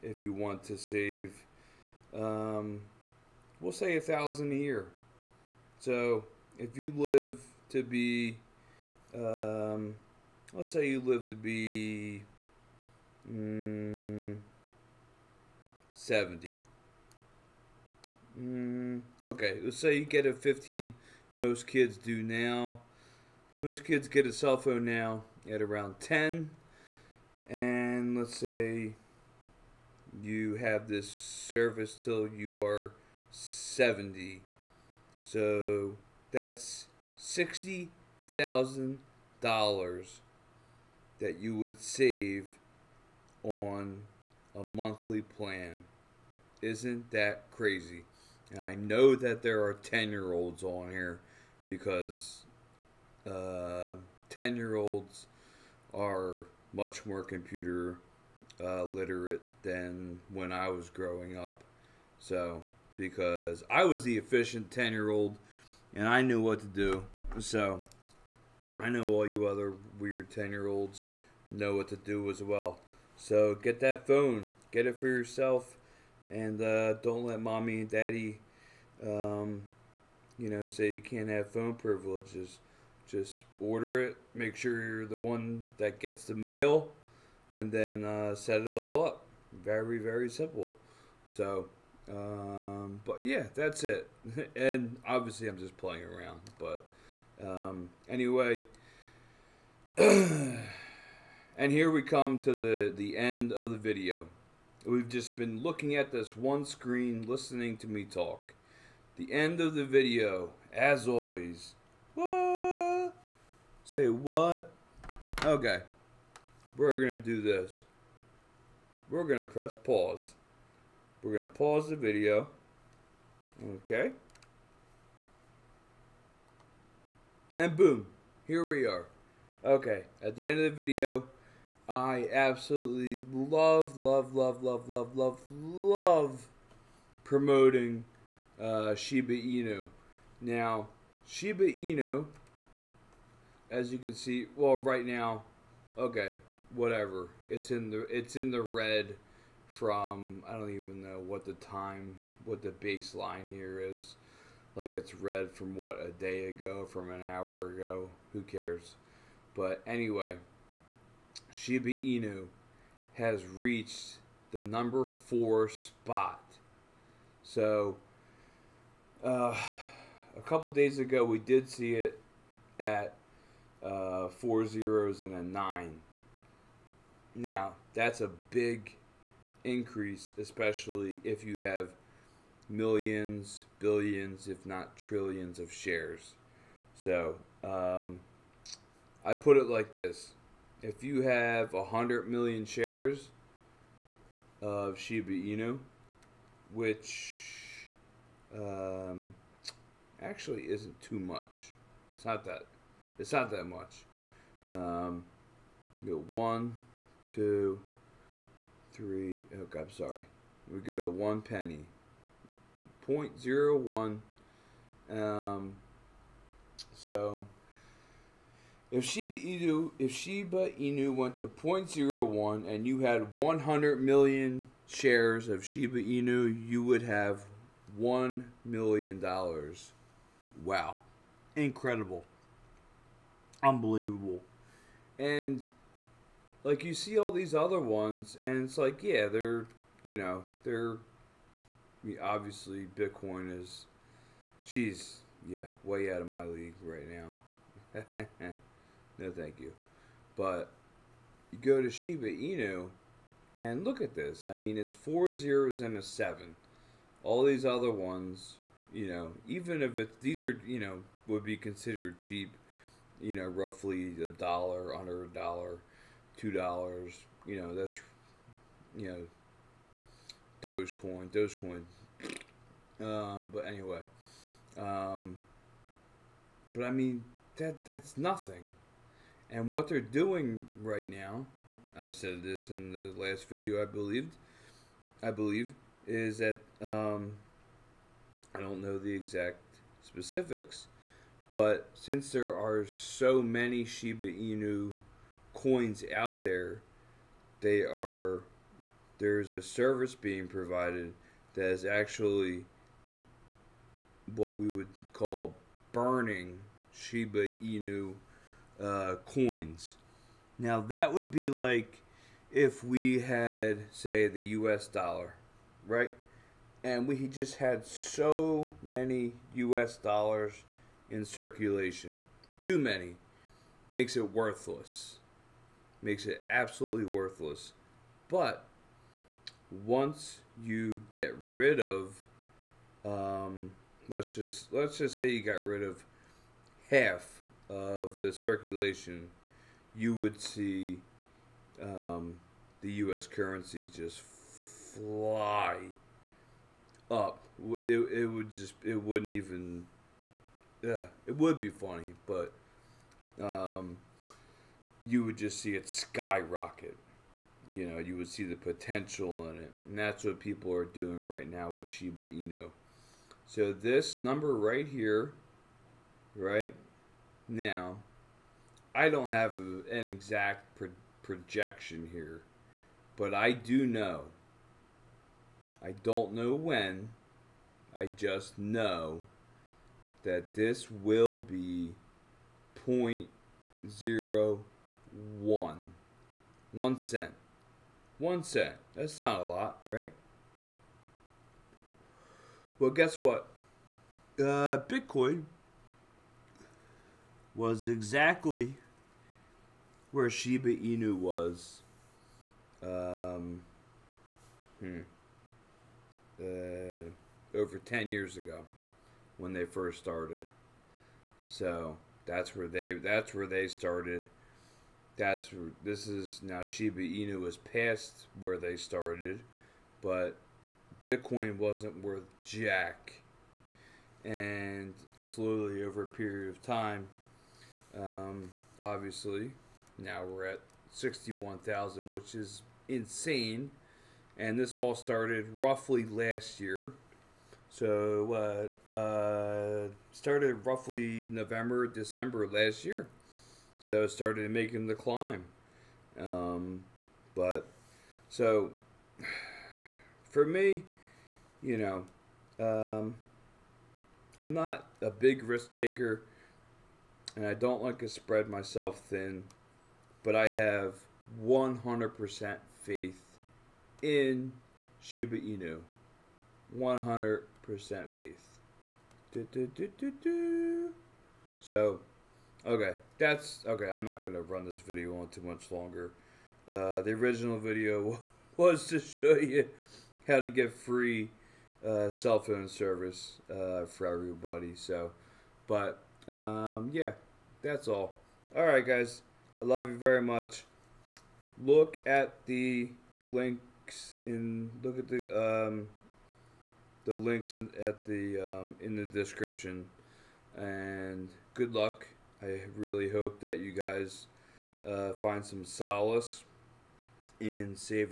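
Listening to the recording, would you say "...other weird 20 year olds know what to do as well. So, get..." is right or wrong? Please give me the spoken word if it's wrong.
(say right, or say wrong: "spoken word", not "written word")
wrong: "10", not "20".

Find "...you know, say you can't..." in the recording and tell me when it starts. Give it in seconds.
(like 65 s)
80 s.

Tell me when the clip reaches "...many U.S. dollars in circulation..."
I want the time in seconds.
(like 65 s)
318 s.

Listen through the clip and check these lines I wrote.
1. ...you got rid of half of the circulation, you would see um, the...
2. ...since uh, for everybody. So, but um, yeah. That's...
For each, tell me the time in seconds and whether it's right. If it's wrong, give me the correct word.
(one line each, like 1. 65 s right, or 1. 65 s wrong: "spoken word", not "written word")
1. 335 s right
2. 482 s wrong: "service", not "since".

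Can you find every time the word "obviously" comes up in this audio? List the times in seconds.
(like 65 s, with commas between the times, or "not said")
95 s, 242 s, 428 s.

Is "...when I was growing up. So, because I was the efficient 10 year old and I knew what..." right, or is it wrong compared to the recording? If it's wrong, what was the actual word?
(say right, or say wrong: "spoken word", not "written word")
right.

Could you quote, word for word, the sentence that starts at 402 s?
Um, hmm, uh, over 10 years ago when they first started.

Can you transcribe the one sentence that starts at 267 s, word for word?
You know, that's, you know, Dogecoin, Dogecoin.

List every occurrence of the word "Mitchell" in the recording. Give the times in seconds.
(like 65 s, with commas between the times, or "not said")
not said.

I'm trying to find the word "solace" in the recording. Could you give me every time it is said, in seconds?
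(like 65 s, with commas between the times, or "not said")
505 s.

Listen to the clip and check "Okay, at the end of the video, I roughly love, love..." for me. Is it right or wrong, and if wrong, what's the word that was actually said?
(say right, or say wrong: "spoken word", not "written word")
wrong: "absolutely", not "roughly".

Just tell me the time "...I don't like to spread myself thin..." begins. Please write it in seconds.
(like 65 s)
457 s.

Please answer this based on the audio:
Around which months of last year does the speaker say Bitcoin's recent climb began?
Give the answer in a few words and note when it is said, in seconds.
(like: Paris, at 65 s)
November, December, at 441 s.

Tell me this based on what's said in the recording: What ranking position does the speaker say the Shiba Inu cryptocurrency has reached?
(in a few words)
number four.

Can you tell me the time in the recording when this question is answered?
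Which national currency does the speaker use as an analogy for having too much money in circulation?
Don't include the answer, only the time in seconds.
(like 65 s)
314 s.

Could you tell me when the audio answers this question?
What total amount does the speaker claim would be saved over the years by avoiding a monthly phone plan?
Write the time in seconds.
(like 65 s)
37 s.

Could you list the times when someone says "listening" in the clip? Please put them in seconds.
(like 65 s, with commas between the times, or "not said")
107 s.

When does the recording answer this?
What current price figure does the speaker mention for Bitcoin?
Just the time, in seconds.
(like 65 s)
430 s.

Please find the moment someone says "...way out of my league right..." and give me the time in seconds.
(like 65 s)
245 s.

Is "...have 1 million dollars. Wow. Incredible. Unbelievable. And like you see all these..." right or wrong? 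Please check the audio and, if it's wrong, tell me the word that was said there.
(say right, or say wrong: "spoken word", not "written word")
right.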